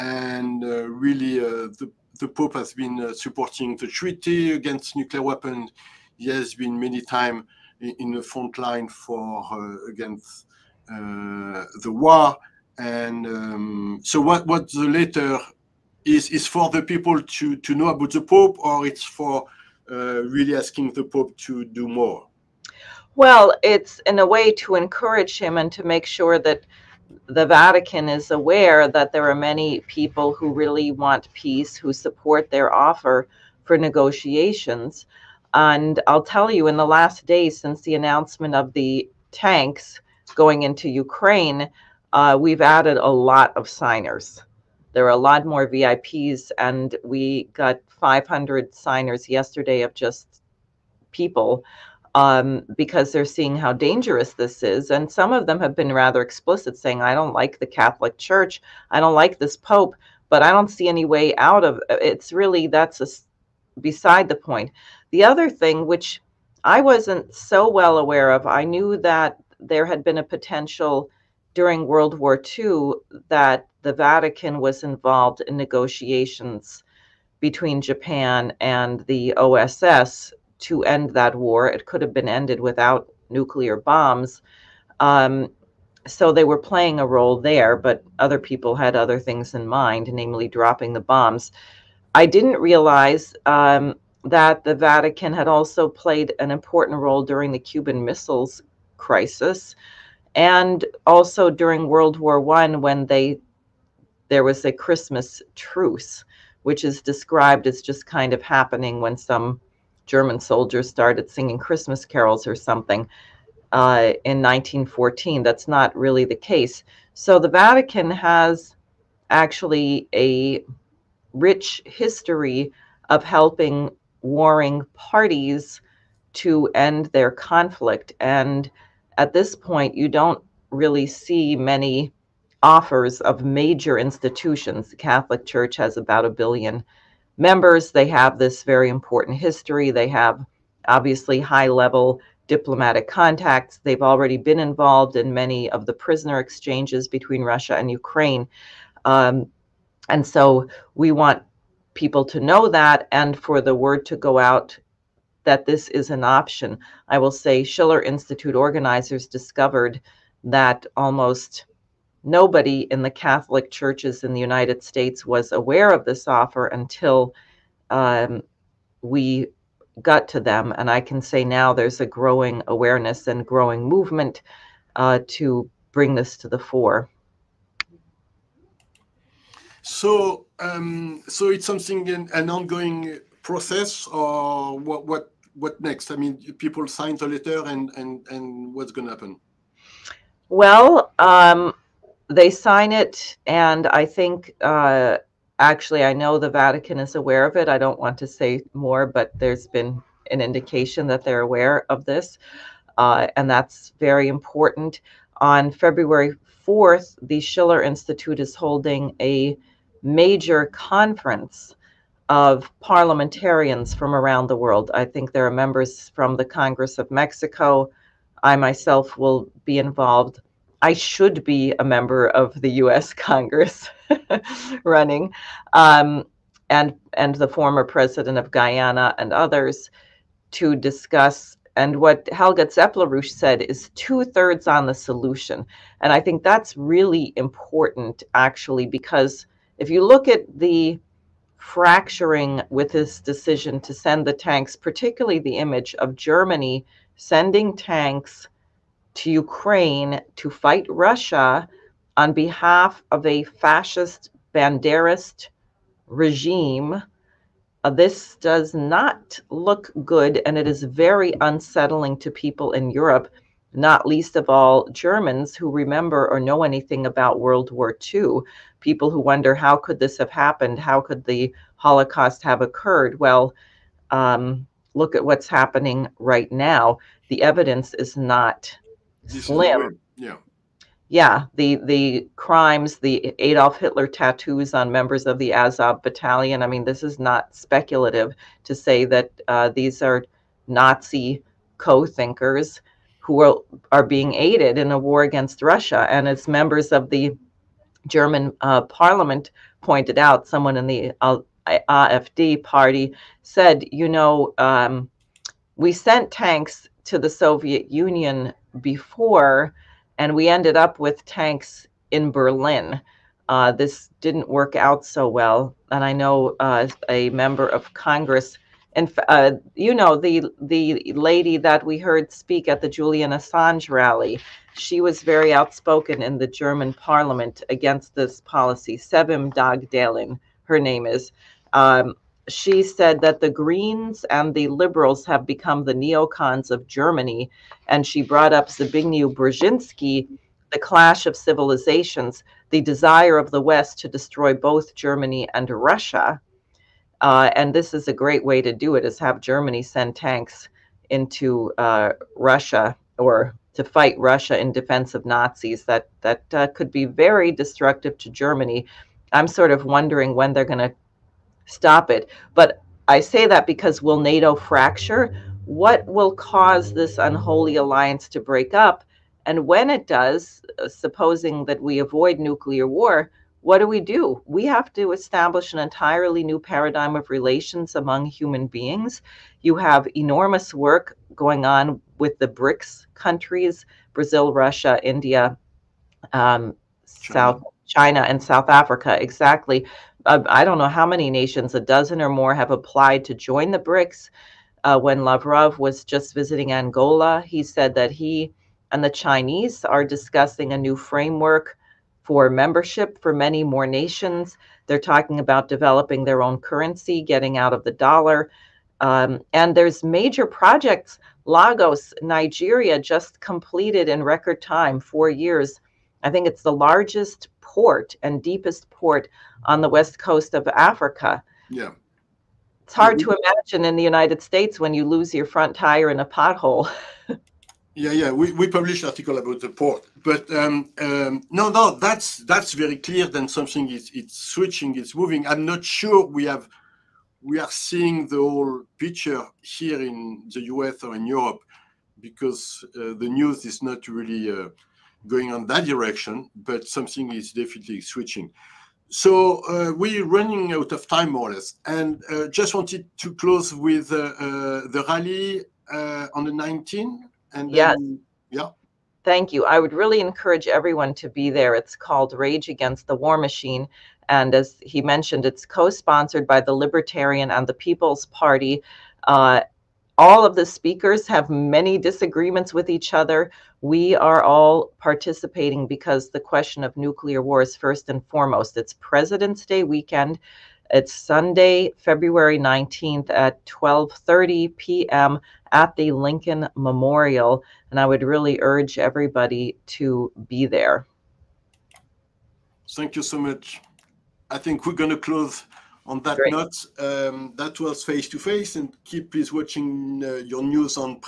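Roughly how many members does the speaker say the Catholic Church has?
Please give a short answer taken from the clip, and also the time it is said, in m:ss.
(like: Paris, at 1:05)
About a billion, at 2:15.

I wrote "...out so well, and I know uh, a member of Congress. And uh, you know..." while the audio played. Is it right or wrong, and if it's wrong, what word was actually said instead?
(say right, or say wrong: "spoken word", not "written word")
right.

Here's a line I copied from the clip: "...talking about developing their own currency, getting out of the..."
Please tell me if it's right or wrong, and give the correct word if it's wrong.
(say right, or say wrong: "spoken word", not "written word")
right.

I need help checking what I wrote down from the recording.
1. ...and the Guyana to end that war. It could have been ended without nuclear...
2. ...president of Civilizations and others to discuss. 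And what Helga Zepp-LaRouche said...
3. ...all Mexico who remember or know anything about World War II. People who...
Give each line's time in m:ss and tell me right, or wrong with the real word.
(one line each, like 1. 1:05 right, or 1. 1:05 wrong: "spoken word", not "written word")
1. 1:18 wrong: "OSS", not "Guyana"
2. 3:47 wrong: "Guyana", not "Civilizations"
3. 4:24 wrong: "Germans", not "Mexico".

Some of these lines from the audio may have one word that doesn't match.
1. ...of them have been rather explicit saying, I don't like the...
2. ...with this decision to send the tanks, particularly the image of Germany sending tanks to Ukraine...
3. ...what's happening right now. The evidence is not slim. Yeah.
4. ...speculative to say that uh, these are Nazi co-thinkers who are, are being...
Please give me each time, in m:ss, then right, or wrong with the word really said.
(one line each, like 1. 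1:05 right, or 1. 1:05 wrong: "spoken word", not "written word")
1. 0:55 right
2. 4:02 right
3. 4:35 right
4. 4:47 right.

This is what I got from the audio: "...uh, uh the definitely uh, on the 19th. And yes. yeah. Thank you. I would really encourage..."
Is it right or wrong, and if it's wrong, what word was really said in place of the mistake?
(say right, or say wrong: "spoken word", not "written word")
wrong: "rally", not "definitely".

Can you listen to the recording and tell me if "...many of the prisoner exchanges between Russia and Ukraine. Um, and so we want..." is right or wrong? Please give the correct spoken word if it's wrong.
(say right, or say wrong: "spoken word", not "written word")
right.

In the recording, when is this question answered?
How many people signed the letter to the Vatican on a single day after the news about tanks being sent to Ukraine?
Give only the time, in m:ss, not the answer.
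0:47.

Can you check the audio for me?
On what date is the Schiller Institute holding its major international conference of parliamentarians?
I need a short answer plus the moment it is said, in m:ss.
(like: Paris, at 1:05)
February 4th, at 3:25.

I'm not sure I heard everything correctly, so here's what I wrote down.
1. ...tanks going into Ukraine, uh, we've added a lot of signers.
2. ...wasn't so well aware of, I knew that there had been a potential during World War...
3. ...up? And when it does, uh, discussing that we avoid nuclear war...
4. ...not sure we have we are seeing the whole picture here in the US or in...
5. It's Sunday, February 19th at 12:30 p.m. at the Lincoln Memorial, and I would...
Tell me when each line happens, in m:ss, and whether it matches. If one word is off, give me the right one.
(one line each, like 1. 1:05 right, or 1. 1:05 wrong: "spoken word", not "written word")
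1. 0:39 right
2. 1:06 right
3. 6:08 wrong: "supposing", not "discussing"
4. 7:15 right
5. 8:00 right.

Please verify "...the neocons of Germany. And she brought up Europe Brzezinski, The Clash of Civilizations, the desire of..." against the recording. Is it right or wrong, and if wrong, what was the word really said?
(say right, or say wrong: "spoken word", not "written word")
wrong: "Zbigniew", not "Europe".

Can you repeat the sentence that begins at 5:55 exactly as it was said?
That that uh, could be very destructive to Germany.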